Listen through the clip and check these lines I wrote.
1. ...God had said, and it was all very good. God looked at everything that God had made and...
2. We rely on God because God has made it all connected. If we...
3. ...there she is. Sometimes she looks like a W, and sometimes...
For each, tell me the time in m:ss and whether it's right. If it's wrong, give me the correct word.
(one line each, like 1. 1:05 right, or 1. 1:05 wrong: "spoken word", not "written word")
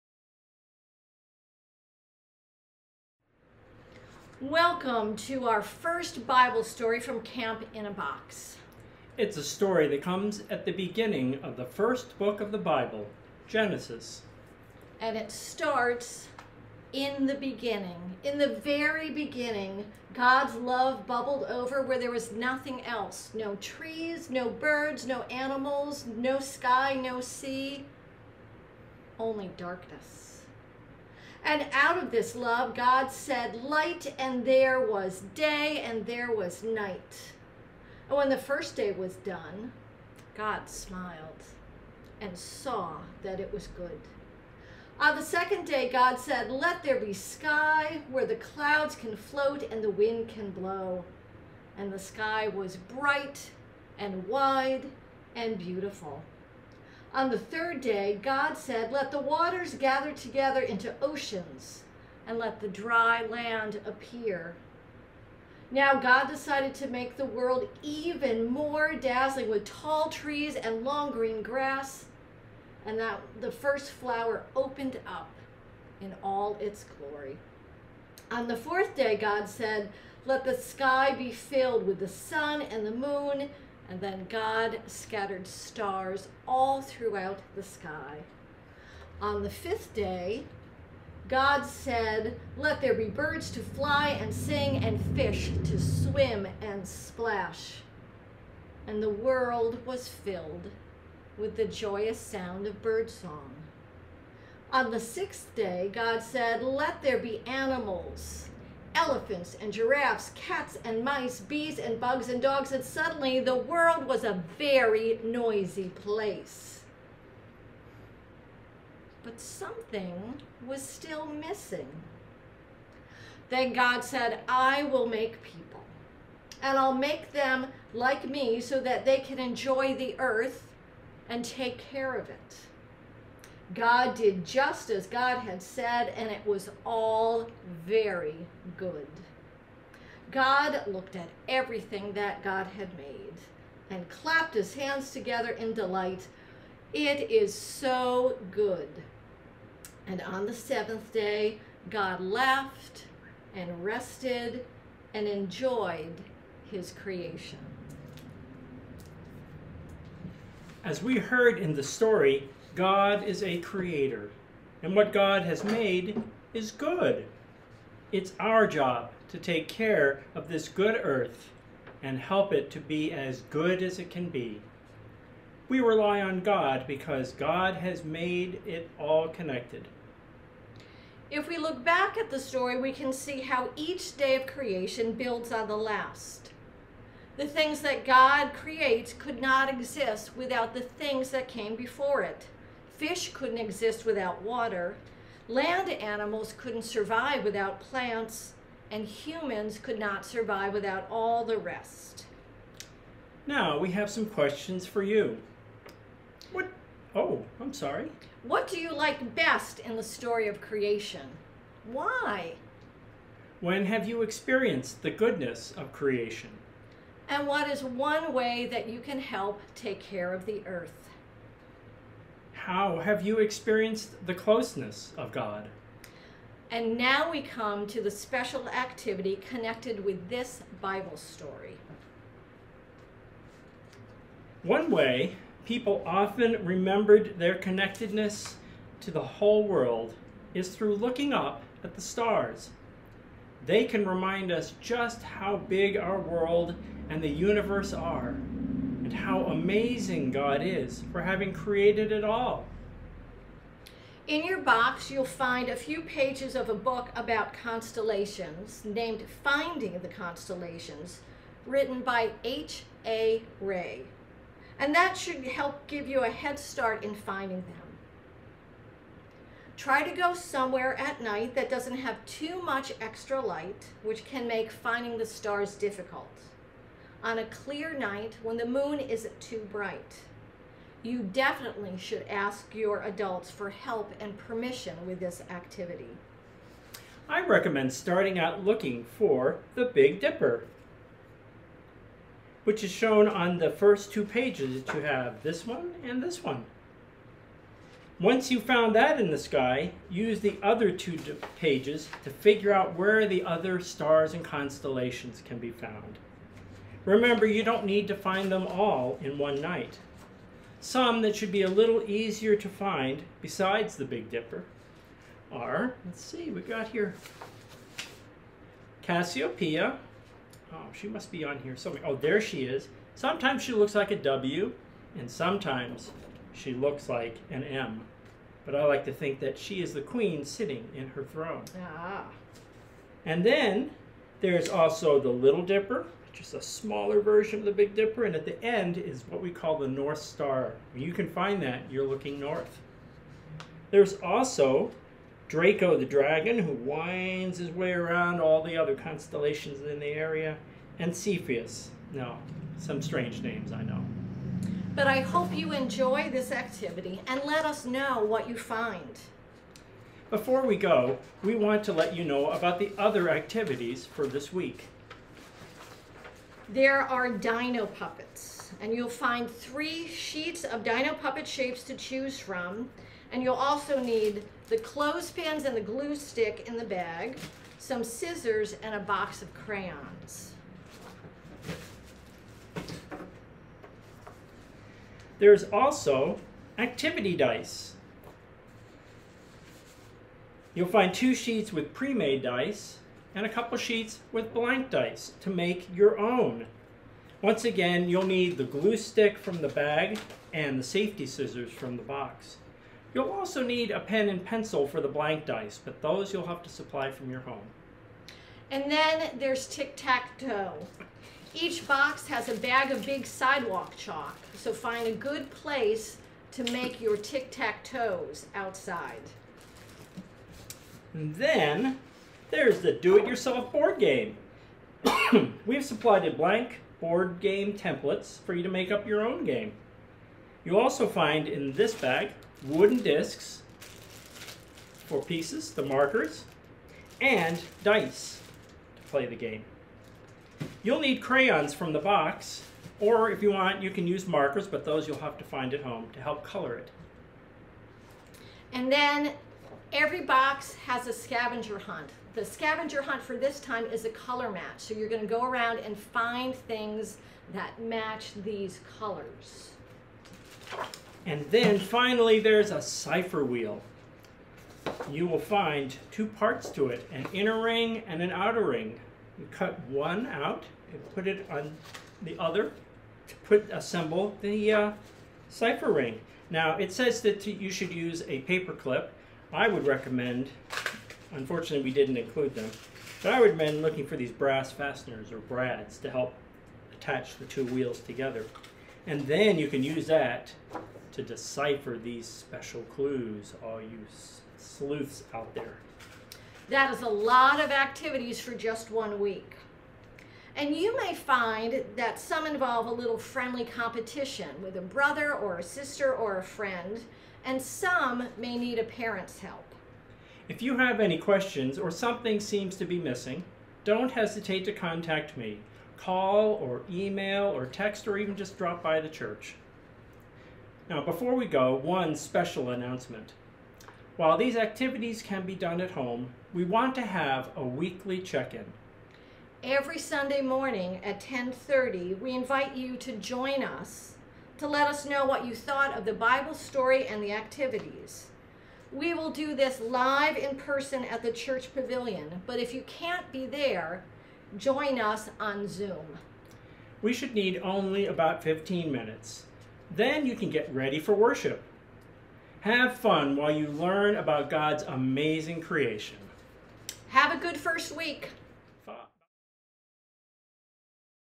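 1. 2:15 right
2. 2:55 right
3. 5:22 right.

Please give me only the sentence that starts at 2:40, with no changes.
As we heard in the story, God is a creator, and what God has made is good.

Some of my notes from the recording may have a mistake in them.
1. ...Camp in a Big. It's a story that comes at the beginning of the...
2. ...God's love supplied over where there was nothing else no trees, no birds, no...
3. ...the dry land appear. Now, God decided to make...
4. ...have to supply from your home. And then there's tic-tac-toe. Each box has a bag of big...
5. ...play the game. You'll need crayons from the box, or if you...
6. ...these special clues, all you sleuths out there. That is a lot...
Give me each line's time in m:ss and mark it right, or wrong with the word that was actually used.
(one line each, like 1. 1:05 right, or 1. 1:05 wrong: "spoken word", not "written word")
1. 0:07 wrong: "Box", not "Big"
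2. 0:20 wrong: "bubbled", not "supplied"
3. 1:02 right
4. 6:46 right
5. 7:19 right
6. 8:12 right.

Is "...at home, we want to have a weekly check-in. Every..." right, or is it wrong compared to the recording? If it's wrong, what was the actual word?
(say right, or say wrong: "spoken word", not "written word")
right.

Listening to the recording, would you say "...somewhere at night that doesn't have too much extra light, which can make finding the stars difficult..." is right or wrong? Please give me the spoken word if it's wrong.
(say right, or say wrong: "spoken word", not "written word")
right.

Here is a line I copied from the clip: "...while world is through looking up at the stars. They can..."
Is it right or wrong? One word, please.
wrong.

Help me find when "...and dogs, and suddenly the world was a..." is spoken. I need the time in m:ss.
1:52.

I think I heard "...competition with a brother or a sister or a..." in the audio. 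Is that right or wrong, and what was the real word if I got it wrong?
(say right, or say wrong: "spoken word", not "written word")
right.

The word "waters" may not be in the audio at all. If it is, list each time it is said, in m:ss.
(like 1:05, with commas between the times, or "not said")
0:59, 3:14.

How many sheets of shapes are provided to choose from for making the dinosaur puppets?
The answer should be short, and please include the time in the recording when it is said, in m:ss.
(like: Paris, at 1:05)
3, at 6:09.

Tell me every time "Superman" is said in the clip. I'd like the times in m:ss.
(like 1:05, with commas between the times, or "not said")
not said.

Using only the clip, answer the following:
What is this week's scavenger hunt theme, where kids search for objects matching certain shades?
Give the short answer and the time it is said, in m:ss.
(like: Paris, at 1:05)
Color match, at 7:34.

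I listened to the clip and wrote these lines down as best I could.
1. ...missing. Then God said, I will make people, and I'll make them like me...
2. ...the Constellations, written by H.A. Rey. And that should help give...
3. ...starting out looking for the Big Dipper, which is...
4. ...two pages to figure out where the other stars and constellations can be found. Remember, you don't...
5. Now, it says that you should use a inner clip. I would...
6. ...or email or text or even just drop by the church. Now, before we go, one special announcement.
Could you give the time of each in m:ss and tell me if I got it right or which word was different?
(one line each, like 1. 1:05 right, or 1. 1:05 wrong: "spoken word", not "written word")
1. 2:01 right
2. 4:19 right
3. 4:47 right
4. 5:00 right
5. 7:56 wrong: "paper", not "inner"
6. 8:36 right.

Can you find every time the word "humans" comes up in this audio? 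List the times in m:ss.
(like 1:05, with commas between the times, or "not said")
3:19.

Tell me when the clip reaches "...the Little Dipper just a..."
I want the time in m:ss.
5:35.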